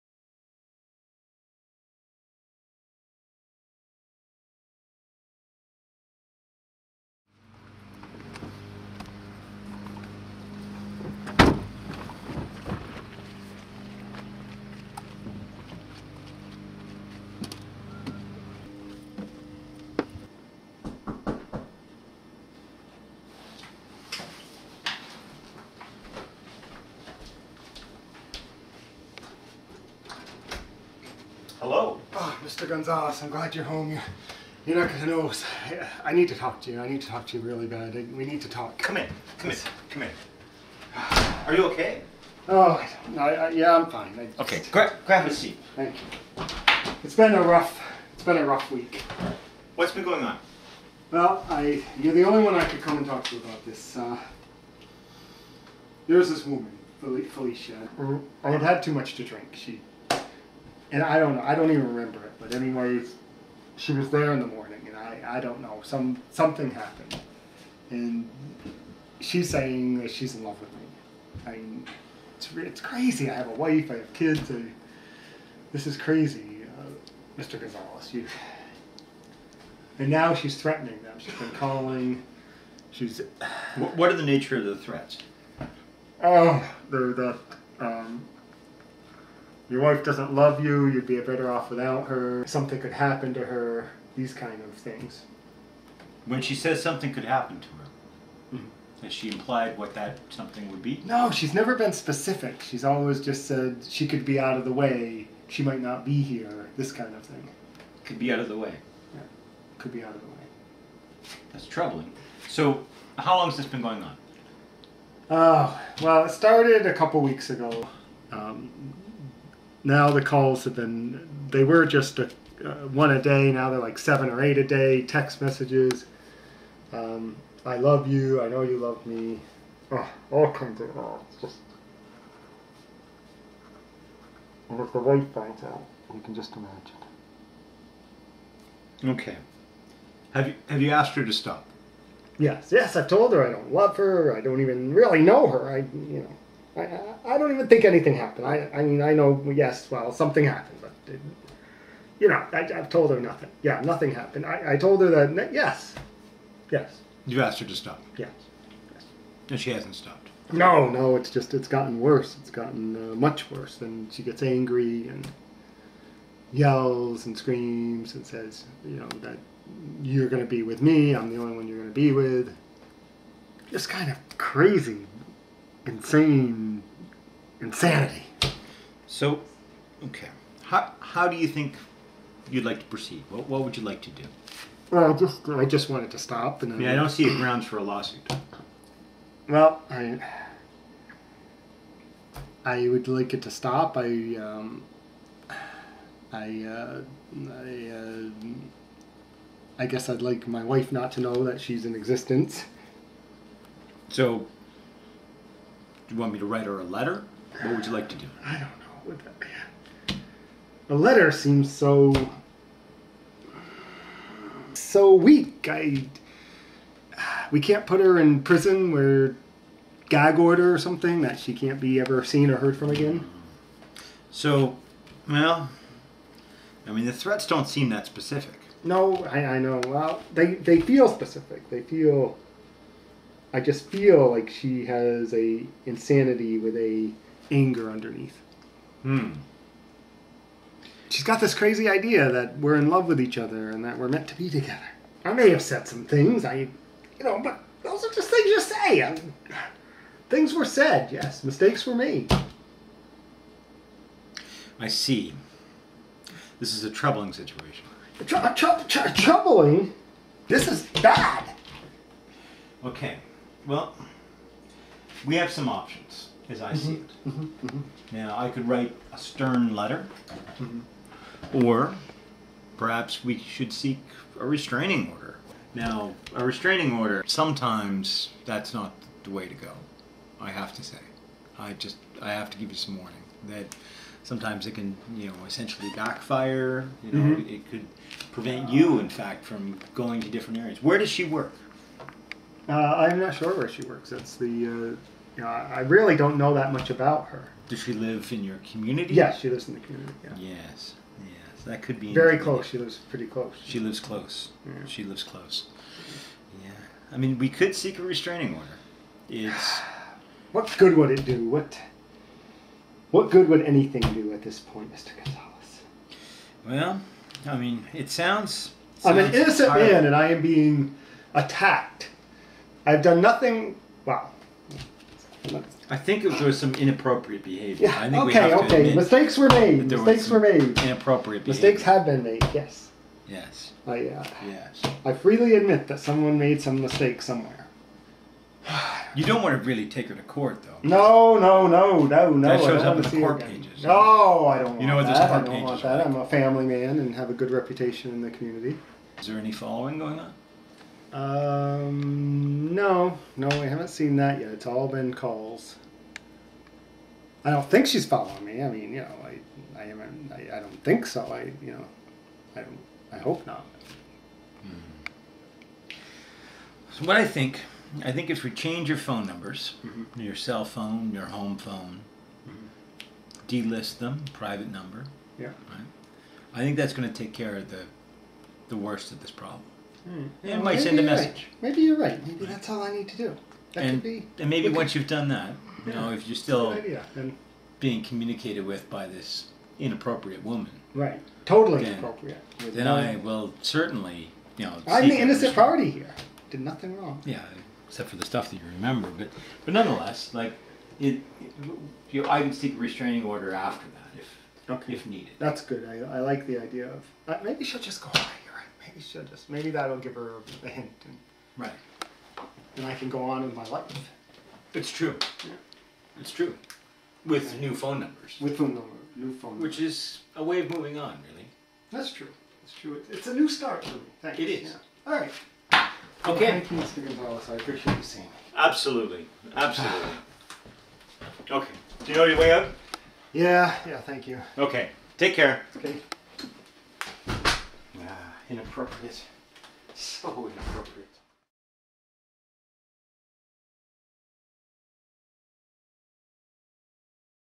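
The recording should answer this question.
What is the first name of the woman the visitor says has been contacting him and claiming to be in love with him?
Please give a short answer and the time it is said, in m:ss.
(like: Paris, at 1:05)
Felicia, at 0:56.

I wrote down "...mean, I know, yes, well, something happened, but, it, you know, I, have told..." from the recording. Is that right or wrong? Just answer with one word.
right.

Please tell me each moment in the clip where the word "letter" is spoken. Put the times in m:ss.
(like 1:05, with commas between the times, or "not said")
3:26, 3:30, 4:29.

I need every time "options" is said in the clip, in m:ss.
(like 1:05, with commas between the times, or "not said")
4:25.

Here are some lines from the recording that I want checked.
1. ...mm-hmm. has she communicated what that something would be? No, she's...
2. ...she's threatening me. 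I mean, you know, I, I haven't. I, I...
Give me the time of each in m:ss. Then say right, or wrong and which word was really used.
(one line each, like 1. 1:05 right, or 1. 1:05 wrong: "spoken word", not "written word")
1. 1:38 wrong: "implied", not "communicated"
2. 5:57 wrong: "following", not "threatening".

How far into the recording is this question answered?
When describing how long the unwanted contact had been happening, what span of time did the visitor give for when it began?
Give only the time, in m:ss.
1:56.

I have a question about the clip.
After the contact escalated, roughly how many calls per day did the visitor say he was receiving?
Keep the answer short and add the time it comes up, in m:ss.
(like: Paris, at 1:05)
7 or 8, at 2:03.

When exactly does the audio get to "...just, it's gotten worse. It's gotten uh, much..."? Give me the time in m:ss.
2:41.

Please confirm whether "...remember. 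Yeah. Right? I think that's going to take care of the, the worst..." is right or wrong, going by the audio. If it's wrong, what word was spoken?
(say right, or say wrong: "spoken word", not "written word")
wrong: "number", not "remember".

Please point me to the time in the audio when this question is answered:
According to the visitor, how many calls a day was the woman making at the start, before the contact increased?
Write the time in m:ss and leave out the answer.
2:02.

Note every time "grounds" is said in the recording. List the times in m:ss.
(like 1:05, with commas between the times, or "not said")
3:07.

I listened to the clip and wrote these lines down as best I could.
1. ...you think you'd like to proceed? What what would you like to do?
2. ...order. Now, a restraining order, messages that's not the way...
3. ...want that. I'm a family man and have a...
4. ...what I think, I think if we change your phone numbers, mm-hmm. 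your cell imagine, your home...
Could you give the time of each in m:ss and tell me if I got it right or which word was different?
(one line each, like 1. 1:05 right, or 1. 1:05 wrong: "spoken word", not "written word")
1. 3:01 right
2. 4:35 wrong: "sometimes", not "messages"
3. 5:45 right
4. 6:07 wrong: "phone", not "imagine".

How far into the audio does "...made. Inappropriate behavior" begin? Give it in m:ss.
5:30.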